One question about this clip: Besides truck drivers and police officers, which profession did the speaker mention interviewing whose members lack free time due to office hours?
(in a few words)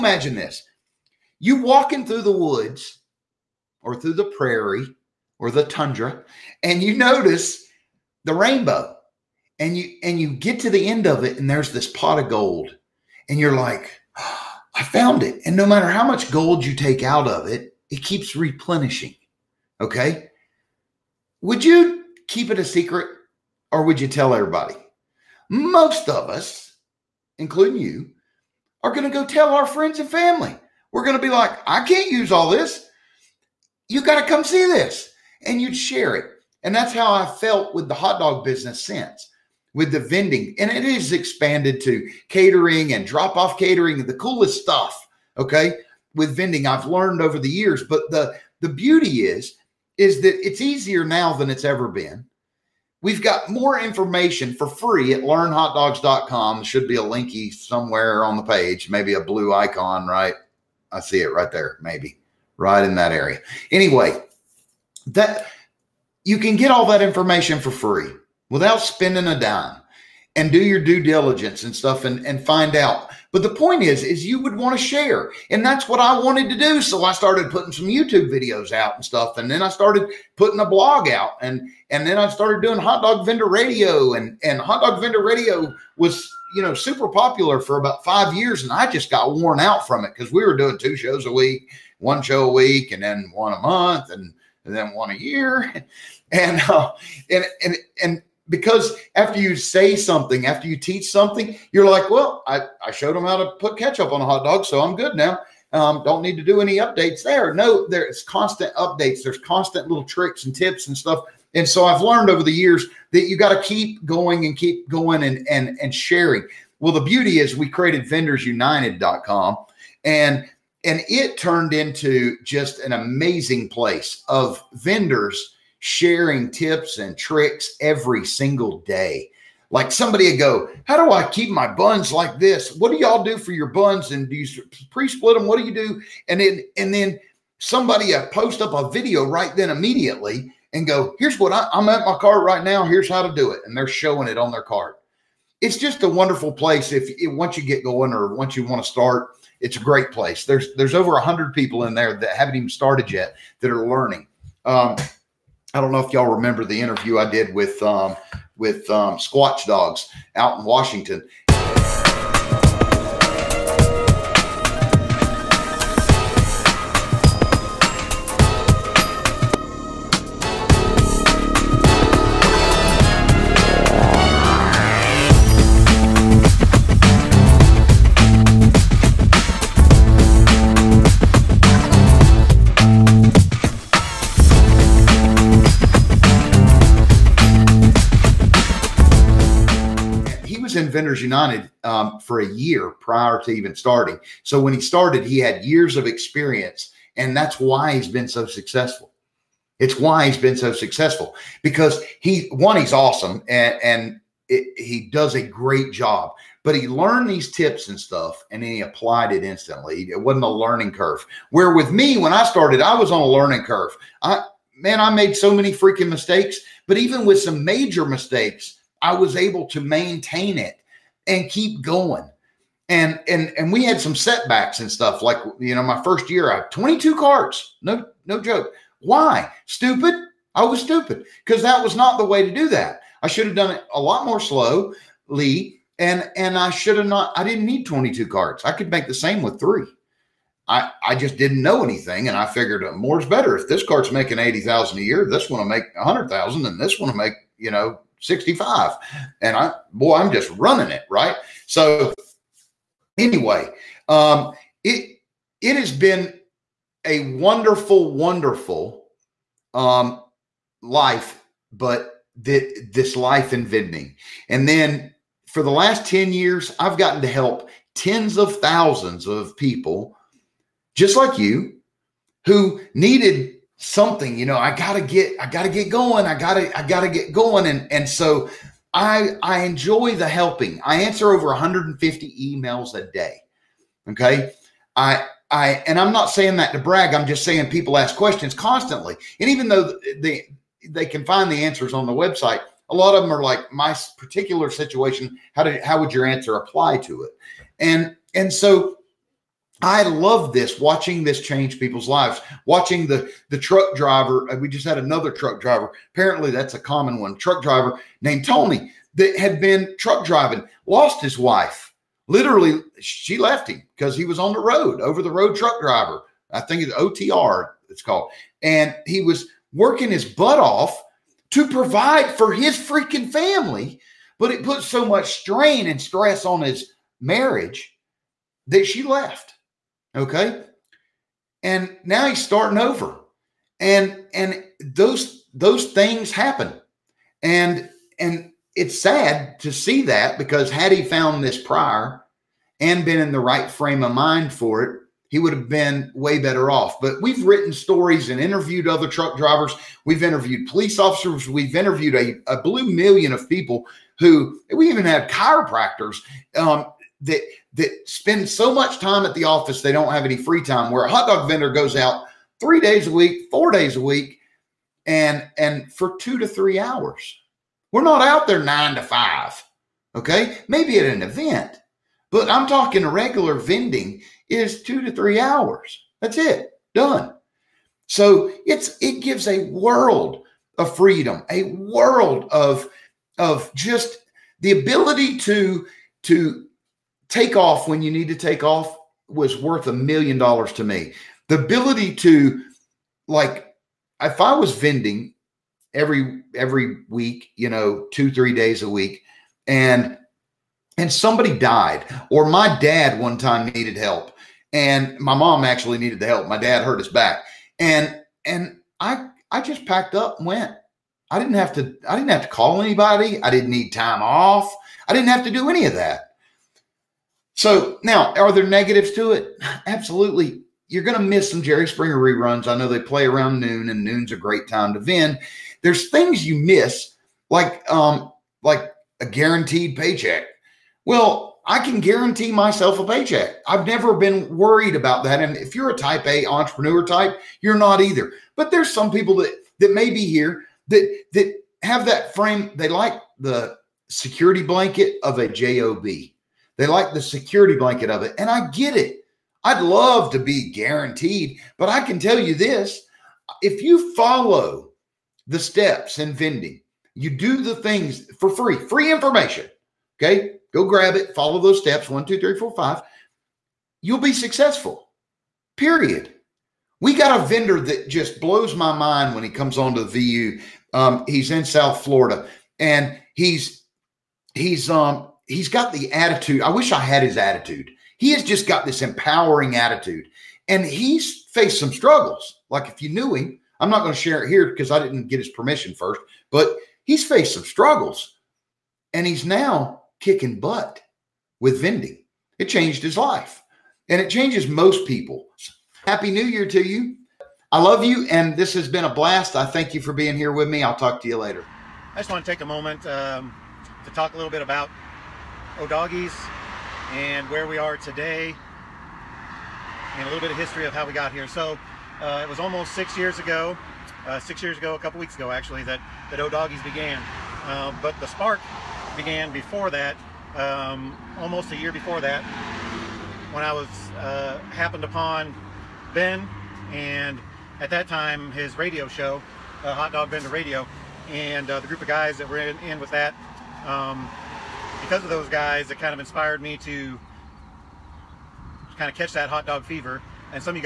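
Chiropractors.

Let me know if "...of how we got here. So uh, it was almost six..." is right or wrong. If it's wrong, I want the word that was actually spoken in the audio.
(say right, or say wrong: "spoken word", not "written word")
right.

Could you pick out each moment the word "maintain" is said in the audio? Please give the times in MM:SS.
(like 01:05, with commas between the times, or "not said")
03:39.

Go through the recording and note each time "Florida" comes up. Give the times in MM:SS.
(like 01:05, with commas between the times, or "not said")
07:52.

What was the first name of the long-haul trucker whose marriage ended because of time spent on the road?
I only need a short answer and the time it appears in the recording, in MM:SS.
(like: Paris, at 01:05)
Tony, at 05:08.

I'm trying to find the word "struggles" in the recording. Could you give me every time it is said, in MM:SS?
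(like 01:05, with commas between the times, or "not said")
08:01, 08:07.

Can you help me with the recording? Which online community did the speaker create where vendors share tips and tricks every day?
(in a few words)
Vendors United.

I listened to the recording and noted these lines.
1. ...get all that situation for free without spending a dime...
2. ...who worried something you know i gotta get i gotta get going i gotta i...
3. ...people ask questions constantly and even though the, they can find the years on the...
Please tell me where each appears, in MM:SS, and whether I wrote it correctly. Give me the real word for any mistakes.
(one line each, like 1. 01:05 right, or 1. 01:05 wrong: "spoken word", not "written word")
1. 01:06 wrong: "information", not "situation"
2. 04:32 wrong: "needed", not "worried"
3. 04:47 wrong: "answers", not "years".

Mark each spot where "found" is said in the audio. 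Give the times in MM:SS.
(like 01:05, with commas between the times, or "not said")
00:14, 05:41.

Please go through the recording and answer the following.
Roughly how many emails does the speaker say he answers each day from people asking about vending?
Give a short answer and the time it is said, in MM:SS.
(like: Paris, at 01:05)
150, at 04:41.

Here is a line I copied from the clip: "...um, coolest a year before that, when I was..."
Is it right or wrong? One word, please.
wrong.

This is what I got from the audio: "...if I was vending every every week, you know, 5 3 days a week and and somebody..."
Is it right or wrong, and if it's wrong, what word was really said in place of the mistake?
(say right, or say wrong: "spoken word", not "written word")
wrong: "2", not "5".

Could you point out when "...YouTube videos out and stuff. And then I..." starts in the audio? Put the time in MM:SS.
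01:17.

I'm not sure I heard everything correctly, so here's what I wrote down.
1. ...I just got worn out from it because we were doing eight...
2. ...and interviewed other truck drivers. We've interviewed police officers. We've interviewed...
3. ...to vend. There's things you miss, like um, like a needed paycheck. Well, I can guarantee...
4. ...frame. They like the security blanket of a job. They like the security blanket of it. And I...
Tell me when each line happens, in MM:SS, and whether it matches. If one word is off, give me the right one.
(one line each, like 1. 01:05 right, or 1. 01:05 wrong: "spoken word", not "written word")
1. 01:28 wrong: "two", not "eight"
2. 05:48 right
3. 07:04 wrong: "guaranteed", not "needed"
4. 07:22 right.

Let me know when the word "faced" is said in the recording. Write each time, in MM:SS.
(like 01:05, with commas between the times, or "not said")
08:01, 08:07.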